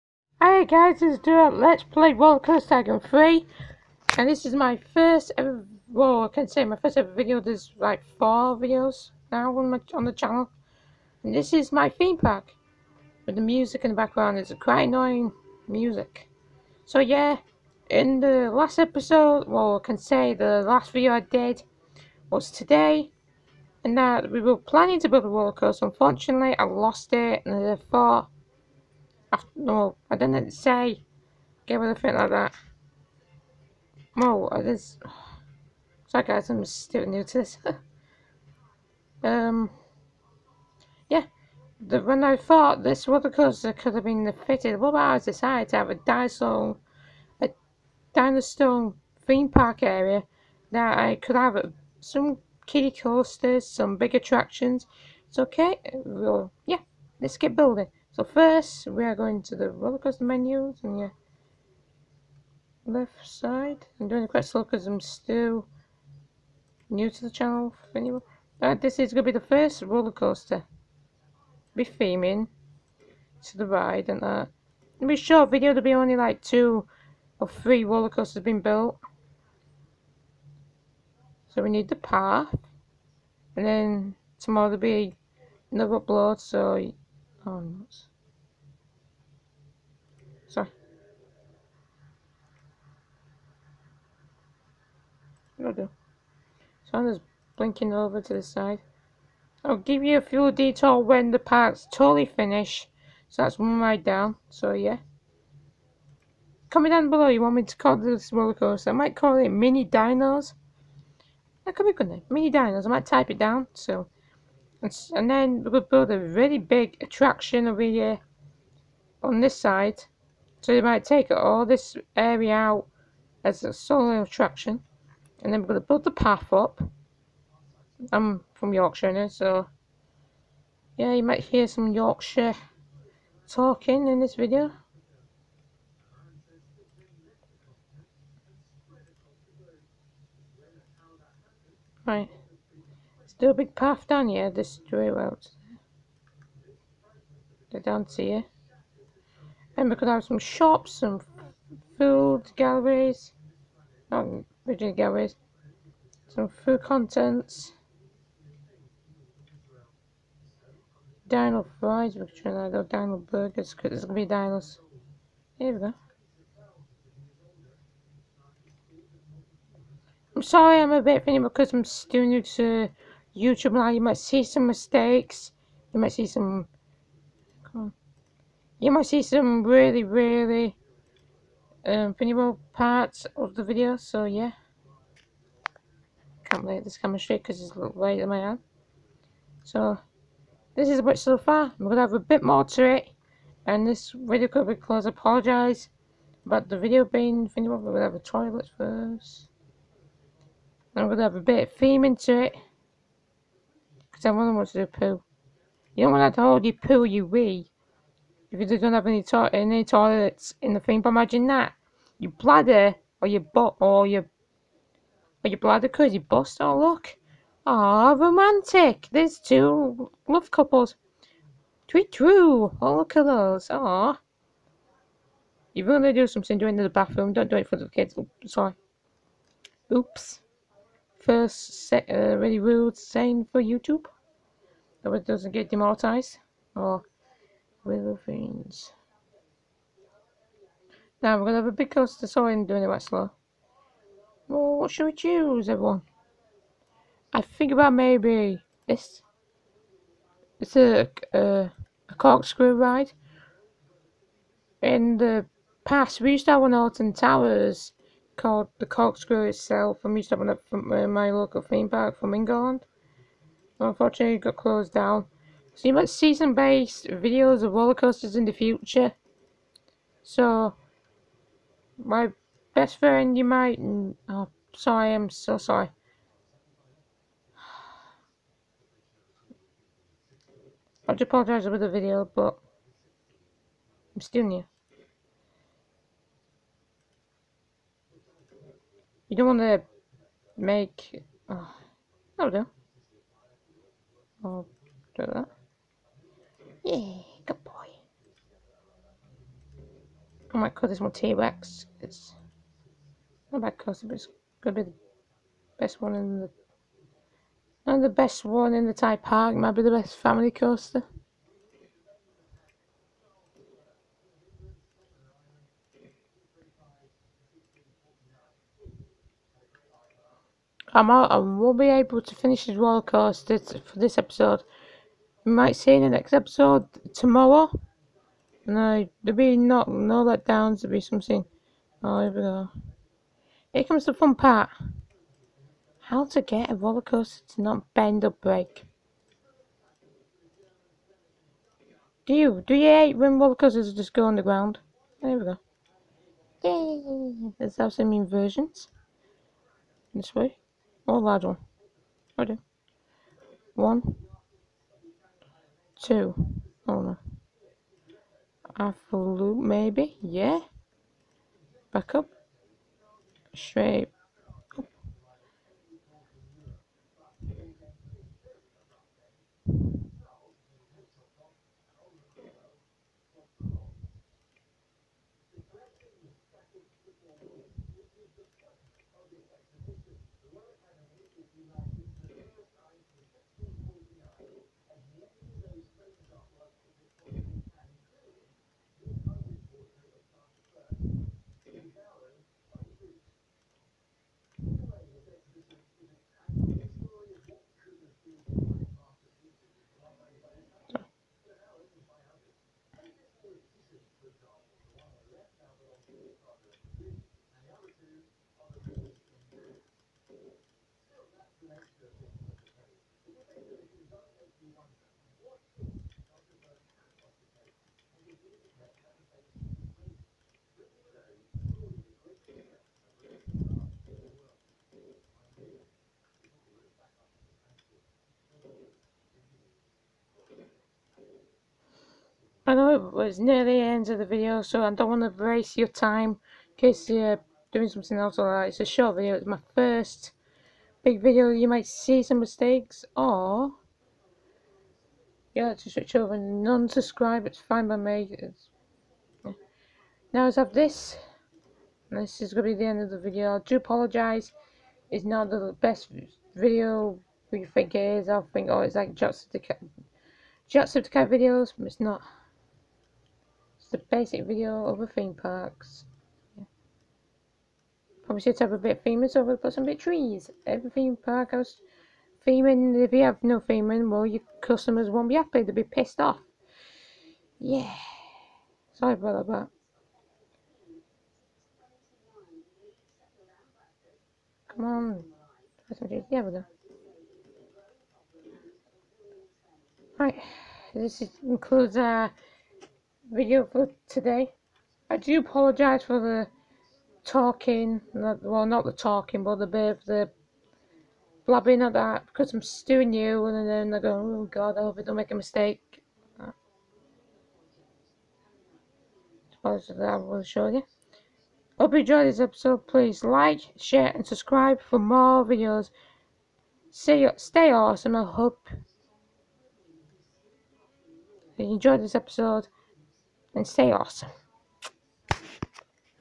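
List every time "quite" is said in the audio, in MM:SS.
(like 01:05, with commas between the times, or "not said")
00:14, 01:04.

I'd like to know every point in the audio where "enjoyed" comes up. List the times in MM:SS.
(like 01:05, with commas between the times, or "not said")
08:31, 08:41.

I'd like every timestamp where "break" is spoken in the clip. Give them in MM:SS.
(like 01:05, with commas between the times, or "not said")
05:38.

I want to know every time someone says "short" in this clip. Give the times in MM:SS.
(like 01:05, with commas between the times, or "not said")
01:15, 07:18.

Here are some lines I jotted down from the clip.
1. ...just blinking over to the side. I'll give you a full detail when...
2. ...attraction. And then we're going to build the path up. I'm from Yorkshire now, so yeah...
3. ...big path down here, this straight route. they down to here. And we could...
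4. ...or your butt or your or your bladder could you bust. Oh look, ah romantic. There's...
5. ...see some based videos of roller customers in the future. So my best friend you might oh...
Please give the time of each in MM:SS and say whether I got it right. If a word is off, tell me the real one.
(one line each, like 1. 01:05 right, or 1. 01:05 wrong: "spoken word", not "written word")
1. 01:37 right
2. 02:04 right
3. 02:23 right
4. 03:33 right
5. 04:26 wrong: "coasters", not "customers".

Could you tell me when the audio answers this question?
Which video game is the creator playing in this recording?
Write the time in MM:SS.
00:02.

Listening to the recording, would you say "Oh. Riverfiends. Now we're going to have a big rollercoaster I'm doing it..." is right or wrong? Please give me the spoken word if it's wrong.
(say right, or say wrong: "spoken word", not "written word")
wrong: "coaster", not "rollercoaster".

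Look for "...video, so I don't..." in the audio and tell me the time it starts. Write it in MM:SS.
07:14.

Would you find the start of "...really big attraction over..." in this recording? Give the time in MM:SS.
01:56.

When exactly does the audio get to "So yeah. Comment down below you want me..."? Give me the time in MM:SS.
01:44.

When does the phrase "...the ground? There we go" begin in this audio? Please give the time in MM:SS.
05:44.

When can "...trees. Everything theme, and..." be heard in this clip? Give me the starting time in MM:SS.
07:49.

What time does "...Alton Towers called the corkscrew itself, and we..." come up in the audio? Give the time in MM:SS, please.
04:16.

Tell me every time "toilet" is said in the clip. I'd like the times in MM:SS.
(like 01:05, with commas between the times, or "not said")
03:18, 03:29.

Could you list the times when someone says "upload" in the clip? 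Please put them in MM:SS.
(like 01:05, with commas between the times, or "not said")
01:26.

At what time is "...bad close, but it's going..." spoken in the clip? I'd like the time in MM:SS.
05:03.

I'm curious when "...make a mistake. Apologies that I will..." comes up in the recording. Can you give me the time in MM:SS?
08:25.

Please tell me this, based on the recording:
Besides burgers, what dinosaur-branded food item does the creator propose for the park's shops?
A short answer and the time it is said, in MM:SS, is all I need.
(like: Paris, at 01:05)
Dino fries, at 02:41.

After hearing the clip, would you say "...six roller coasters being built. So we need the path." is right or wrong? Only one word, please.
wrong.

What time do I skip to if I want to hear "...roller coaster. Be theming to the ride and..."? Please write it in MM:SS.
01:09.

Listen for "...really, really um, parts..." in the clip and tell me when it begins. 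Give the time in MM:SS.
02:59.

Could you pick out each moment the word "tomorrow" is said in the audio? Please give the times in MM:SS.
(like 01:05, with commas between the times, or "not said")
01:24, 05:27.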